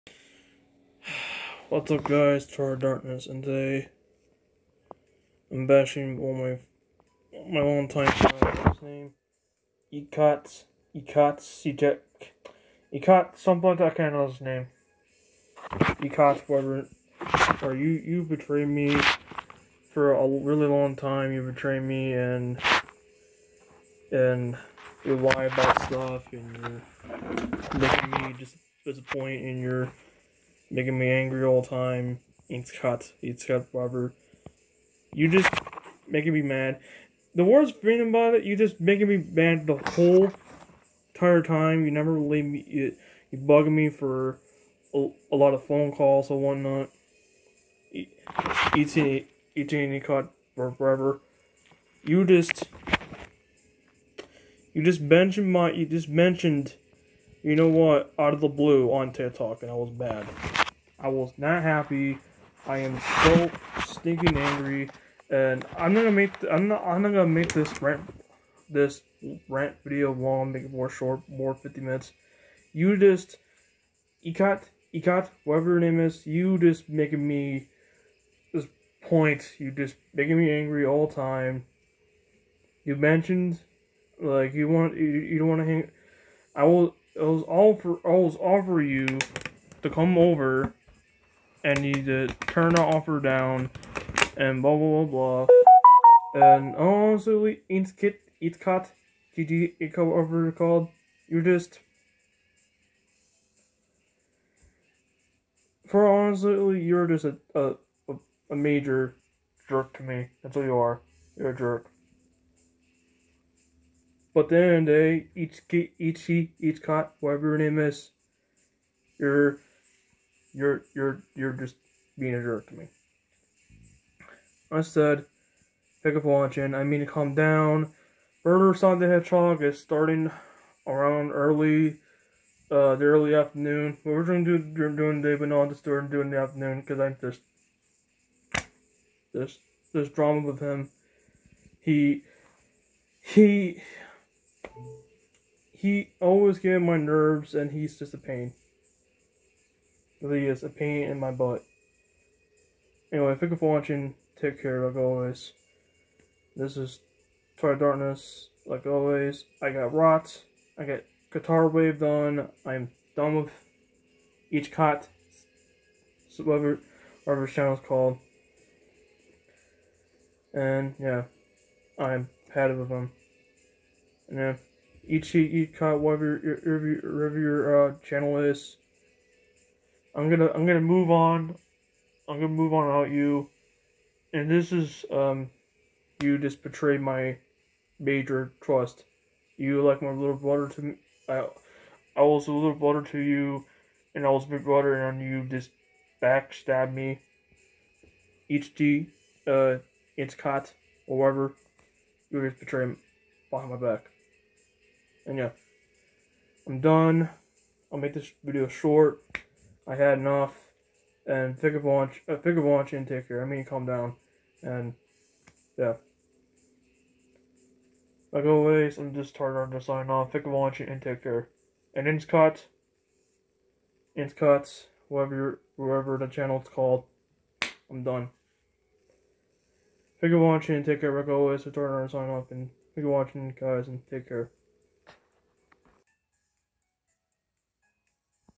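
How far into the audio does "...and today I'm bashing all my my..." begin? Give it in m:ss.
0:03.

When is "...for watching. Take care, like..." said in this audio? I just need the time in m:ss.
2:33.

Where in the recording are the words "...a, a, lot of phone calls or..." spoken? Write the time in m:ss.
0:44.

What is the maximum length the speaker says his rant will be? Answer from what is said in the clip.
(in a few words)
50 minutes.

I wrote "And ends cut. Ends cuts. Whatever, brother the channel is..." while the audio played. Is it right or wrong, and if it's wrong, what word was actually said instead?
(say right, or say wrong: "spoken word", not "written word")
wrong: "whatever", not "brother".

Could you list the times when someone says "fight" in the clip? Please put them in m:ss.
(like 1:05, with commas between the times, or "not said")
not said.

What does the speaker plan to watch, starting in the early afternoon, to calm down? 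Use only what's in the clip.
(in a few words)
Murder Sonic the Hedgehog.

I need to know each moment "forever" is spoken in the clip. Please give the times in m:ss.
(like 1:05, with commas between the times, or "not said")
0:33, 0:50.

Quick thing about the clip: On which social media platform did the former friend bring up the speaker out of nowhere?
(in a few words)
TikTok.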